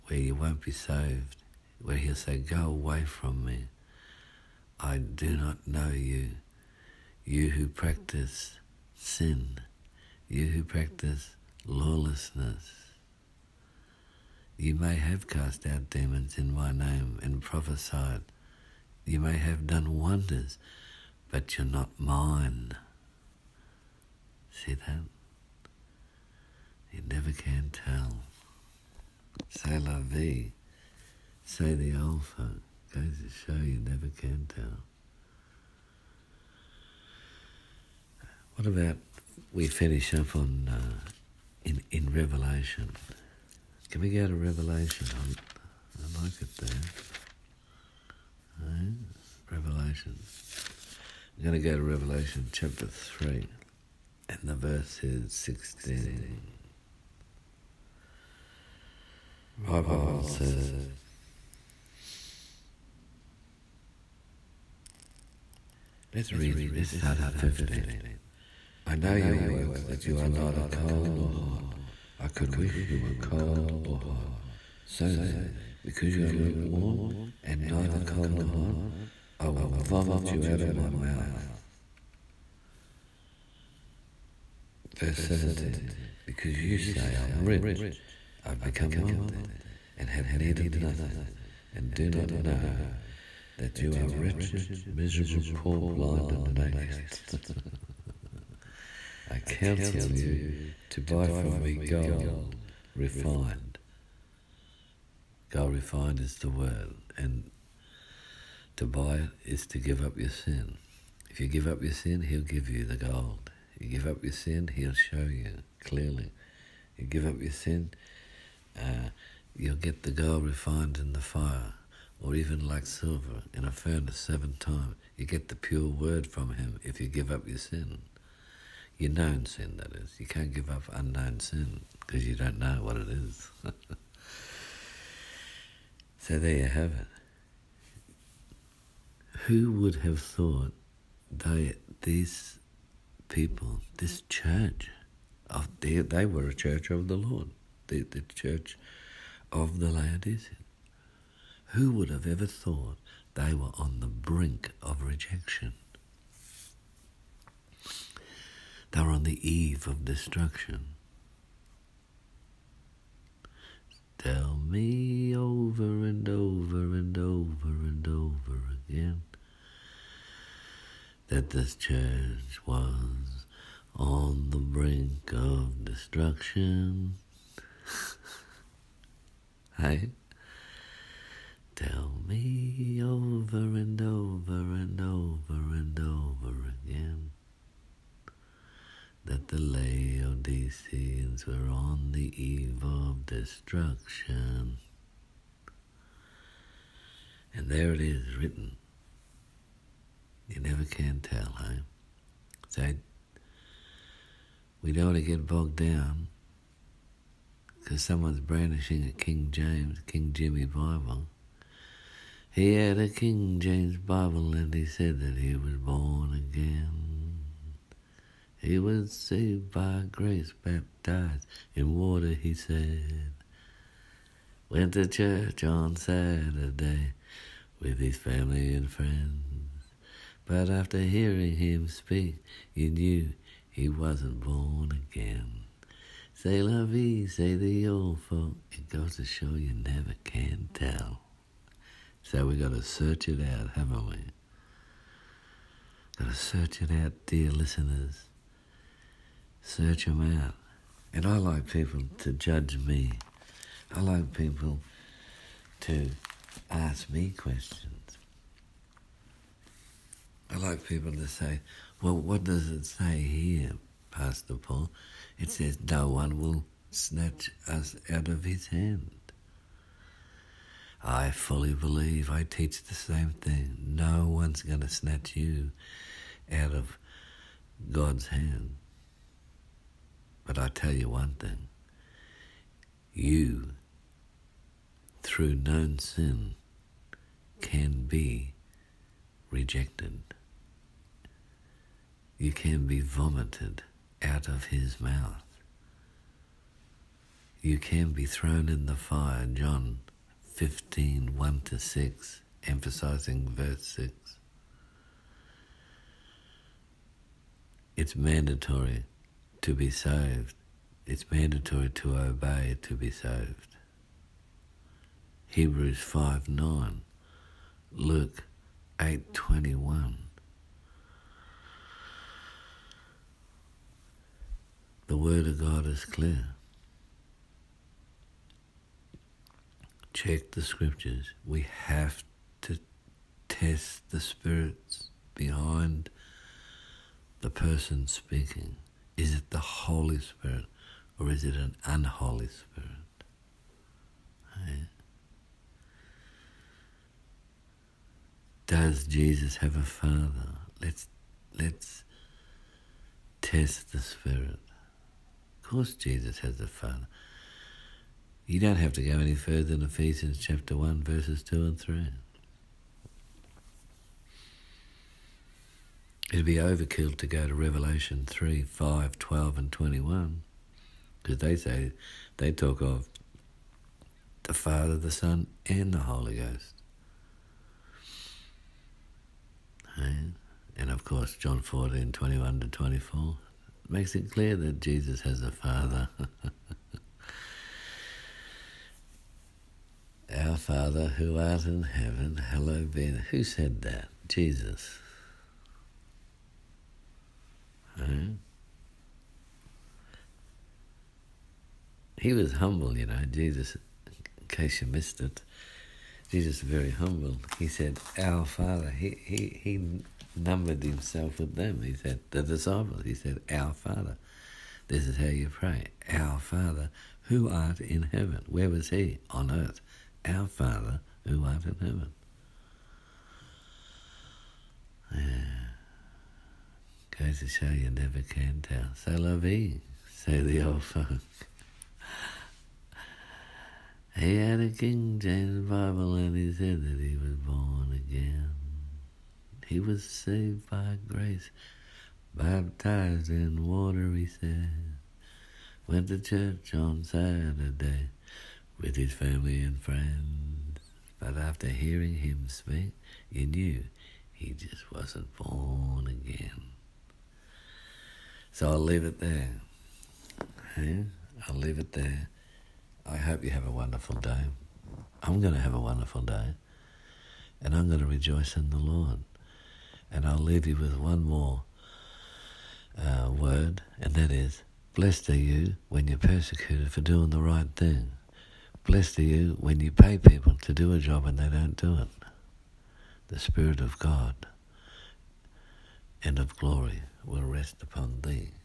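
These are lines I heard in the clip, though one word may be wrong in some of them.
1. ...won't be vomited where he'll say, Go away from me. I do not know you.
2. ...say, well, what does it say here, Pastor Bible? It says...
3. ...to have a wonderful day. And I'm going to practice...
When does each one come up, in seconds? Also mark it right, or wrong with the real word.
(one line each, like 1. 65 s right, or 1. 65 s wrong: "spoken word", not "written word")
1. 0 s wrong: "saved", not "vomited"
2. 261 s wrong: "Paul", not "Bible"
3. 465 s wrong: "rejoice", not "practice".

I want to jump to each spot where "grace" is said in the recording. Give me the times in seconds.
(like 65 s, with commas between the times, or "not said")
220 s, 441 s.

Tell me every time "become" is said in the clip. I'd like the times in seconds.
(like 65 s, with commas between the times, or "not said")
88 s.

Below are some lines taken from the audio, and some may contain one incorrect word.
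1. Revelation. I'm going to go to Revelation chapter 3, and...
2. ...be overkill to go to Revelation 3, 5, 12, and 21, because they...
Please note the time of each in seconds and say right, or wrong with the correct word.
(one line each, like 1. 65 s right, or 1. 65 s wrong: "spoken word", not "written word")
1. 49 s right
2. 366 s right.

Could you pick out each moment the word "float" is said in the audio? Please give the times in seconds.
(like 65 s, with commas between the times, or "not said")
not said.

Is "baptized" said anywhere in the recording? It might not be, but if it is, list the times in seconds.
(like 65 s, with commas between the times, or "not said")
220 s, 442 s.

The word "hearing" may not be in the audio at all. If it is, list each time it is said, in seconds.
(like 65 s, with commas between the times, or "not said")
230 s, 451 s.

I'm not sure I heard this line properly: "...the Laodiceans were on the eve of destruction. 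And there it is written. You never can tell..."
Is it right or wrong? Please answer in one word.
right.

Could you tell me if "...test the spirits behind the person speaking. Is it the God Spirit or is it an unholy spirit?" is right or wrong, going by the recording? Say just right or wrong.
wrong.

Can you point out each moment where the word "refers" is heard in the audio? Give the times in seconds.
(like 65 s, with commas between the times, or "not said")
not said.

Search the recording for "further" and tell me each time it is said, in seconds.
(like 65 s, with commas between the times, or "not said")
359 s.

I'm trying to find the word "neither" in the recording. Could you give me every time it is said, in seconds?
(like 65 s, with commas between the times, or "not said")
70 s, 77 s.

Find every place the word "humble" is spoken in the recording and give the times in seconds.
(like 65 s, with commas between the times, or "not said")
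402 s, 406 s.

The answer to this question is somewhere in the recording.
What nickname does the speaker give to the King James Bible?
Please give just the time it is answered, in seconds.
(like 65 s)
210 s.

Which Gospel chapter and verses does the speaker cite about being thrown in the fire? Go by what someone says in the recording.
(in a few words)
John 15:1-6.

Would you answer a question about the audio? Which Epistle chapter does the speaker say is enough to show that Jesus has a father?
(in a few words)
Ephesians 1.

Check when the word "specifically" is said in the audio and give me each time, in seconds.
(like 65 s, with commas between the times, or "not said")
not said.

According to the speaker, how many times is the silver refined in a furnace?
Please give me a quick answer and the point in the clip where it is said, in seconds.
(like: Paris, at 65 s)
7, at 124 s.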